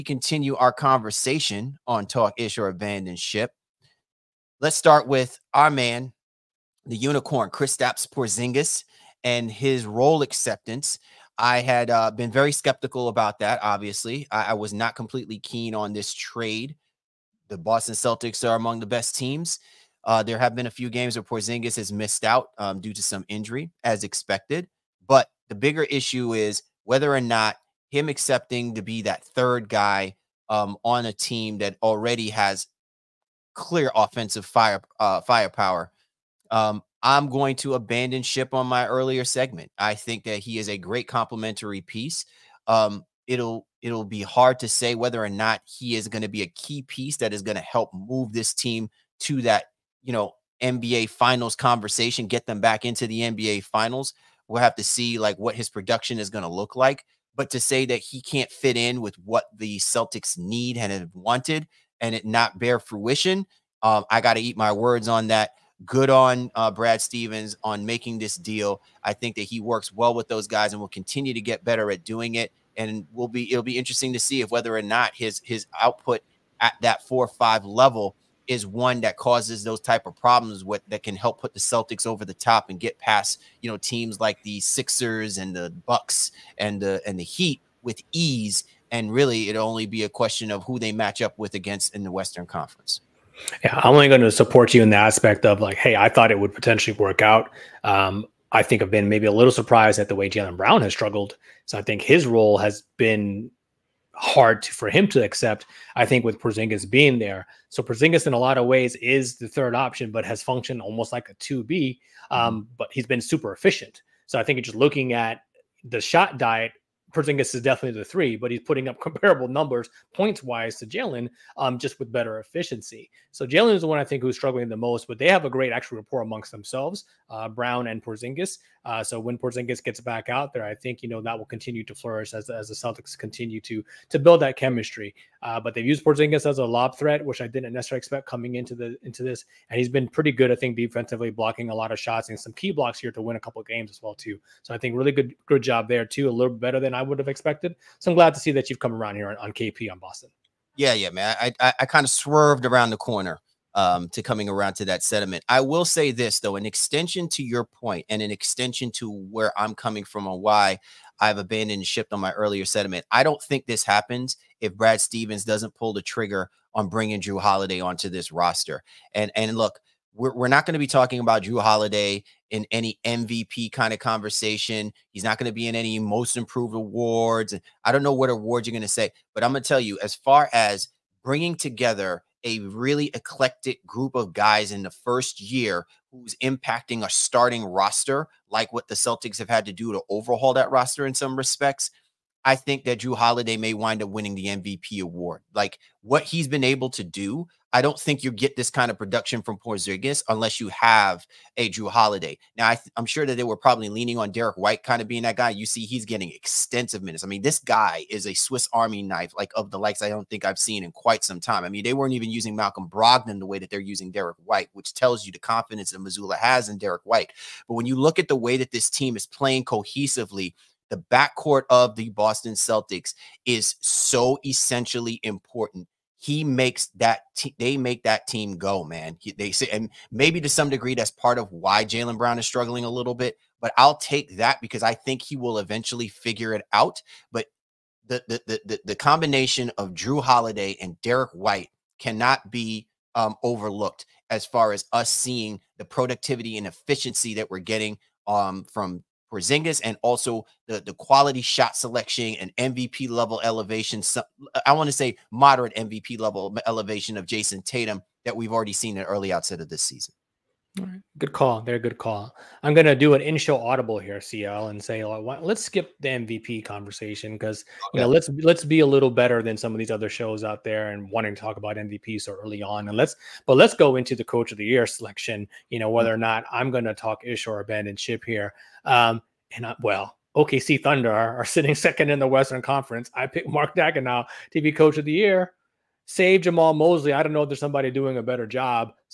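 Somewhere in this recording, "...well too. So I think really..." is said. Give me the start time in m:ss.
2:24.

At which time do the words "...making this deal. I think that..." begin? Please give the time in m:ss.
1:07.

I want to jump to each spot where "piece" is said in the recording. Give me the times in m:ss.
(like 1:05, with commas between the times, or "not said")
0:41, 0:46.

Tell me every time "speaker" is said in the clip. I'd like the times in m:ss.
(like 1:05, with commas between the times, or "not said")
not said.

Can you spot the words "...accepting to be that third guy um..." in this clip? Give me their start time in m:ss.
0:28.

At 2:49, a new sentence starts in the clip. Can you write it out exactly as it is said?
And and look, we're, we're not going to be talking about Jrue Holiday in any MVP kind of conversation.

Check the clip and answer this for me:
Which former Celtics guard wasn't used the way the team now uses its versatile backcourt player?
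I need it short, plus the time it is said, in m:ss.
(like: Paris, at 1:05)
Malcolm Brogdon, at 3:32.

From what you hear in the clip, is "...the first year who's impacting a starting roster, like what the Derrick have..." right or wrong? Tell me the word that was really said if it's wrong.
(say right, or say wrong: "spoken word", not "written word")
wrong: "Celtics", not "Derrick".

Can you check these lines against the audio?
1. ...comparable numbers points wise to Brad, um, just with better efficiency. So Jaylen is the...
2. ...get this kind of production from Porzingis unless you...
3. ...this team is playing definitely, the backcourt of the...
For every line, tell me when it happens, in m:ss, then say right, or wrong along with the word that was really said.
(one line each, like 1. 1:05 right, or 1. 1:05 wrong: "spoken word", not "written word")
1. 1:59 wrong: "Jaylen", not "Brad"
2. 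3:18 right
3. 3:38 wrong: "cohesively", not "definitely".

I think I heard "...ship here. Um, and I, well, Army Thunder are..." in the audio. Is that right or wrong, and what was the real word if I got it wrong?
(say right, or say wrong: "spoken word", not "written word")
wrong: "OKC", not "Army".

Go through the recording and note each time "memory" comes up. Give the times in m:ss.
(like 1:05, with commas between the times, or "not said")
not said.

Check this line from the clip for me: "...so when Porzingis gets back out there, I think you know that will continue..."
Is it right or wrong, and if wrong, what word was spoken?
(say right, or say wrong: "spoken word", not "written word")
right.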